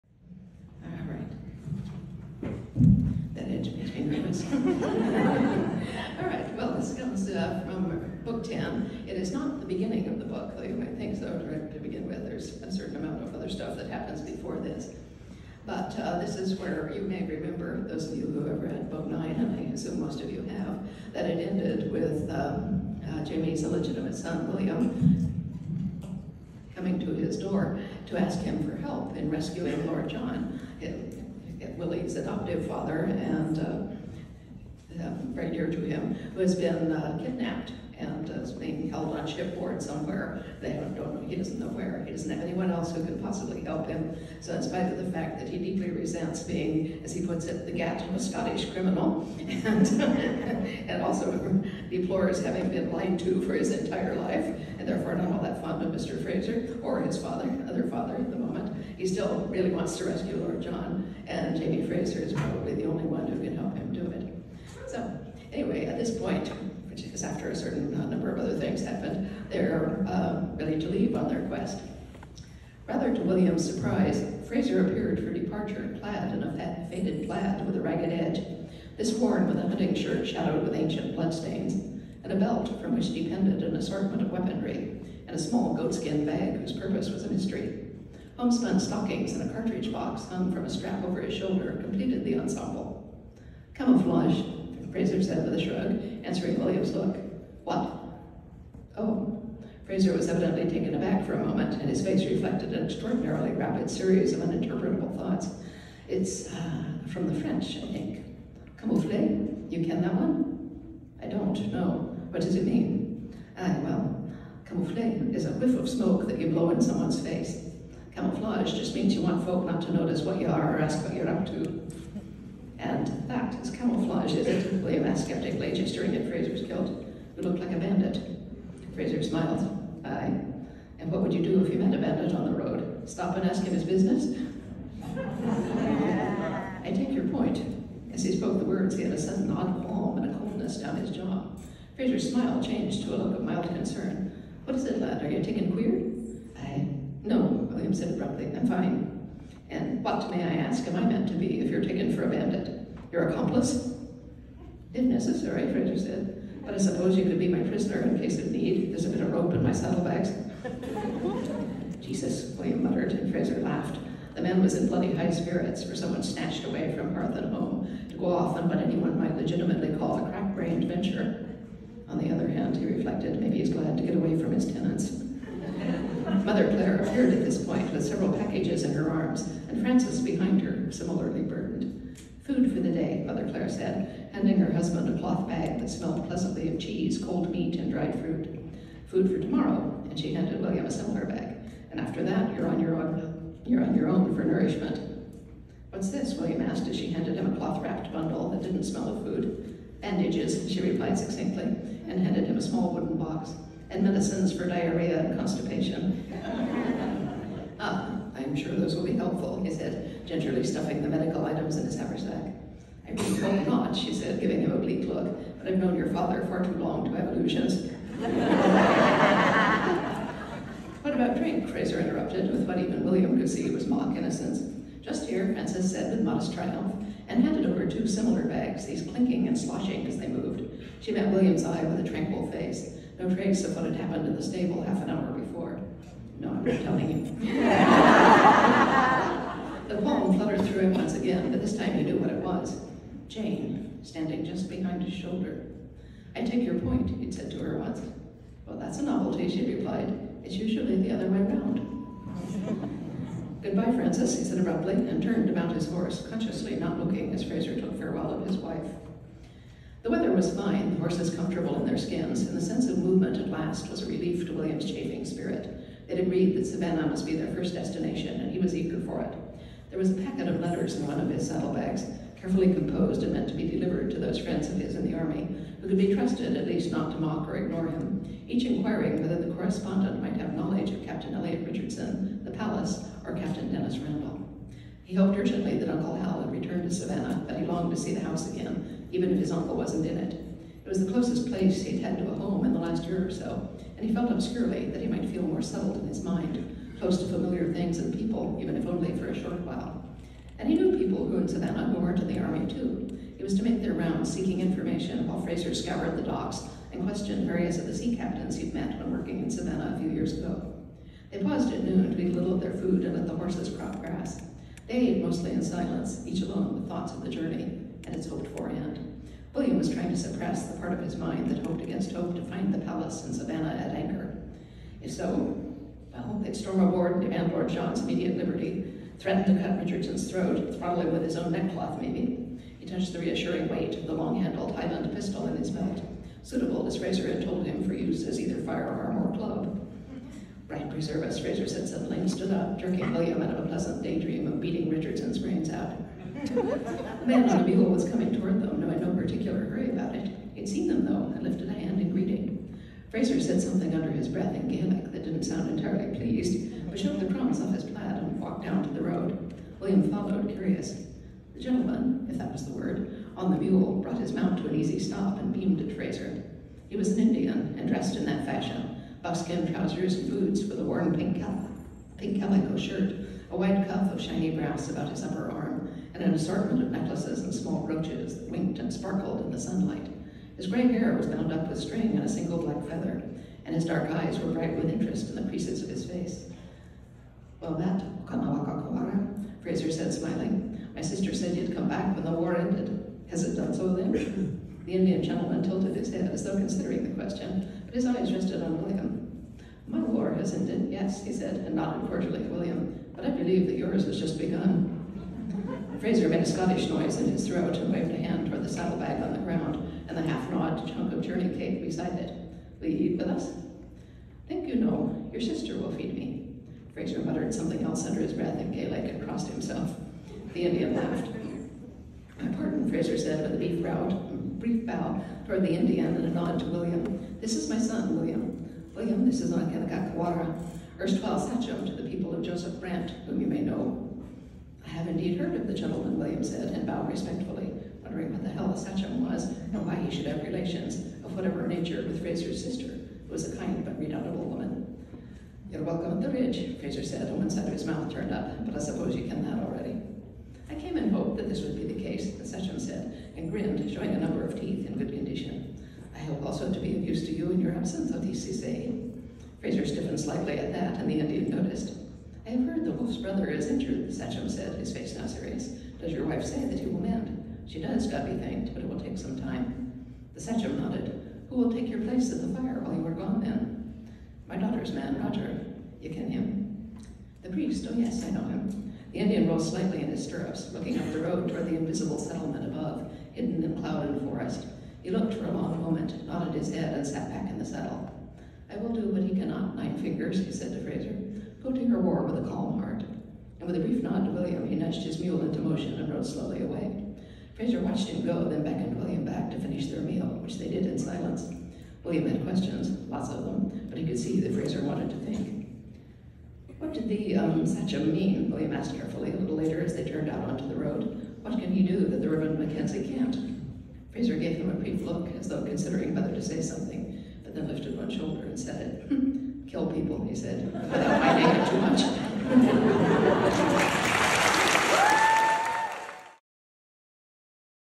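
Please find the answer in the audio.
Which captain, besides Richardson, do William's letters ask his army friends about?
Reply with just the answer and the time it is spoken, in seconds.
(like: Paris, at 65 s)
Captain Denys Randall, at 283 s.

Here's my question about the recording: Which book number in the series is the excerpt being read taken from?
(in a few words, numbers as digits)
Book 10.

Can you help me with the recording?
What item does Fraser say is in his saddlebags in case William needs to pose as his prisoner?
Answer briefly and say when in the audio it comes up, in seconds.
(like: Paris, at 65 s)
Rope, at 159 s.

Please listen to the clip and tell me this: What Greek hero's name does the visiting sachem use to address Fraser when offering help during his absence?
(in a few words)
Odysseus.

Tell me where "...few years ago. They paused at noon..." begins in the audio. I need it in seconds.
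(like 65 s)
309 s.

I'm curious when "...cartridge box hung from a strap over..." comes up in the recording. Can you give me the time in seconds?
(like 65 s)
89 s.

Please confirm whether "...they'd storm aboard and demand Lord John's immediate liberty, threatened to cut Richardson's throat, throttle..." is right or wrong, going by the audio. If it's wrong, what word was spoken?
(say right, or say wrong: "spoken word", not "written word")
right.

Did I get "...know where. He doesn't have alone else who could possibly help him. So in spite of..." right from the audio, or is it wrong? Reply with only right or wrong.
wrong.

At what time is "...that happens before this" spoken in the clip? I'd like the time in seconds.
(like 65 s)
13 s.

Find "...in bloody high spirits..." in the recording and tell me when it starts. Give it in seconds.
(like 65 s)
164 s.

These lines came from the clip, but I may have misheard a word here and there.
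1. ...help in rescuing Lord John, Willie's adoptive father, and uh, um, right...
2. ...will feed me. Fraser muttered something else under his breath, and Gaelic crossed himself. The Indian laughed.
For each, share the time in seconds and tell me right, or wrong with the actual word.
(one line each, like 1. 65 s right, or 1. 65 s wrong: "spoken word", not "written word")
1. 28 s right
2. 415 s right.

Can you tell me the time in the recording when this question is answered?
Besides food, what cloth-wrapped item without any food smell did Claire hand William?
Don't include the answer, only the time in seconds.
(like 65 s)
200 s.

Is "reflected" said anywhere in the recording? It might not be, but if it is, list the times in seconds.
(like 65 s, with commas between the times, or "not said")
102 s, 172 s.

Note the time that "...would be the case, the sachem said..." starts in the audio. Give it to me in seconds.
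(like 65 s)
451 s.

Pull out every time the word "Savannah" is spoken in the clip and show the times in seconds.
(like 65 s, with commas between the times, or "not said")
266 s, 286 s, 301 s, 309 s, 323 s.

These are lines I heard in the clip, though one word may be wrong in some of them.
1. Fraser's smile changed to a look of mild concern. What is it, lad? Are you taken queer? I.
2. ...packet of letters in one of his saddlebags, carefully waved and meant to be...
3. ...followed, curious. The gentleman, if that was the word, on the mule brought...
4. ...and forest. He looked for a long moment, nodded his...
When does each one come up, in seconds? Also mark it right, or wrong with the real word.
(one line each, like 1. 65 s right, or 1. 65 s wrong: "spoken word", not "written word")
1. 141 s right
2. 270 s wrong: "composed", not "waved"
3. 360 s right
4. 484 s right.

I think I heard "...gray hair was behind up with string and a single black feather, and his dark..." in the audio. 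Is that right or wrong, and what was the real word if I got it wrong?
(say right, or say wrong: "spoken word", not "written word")
wrong: "bound", not "behind".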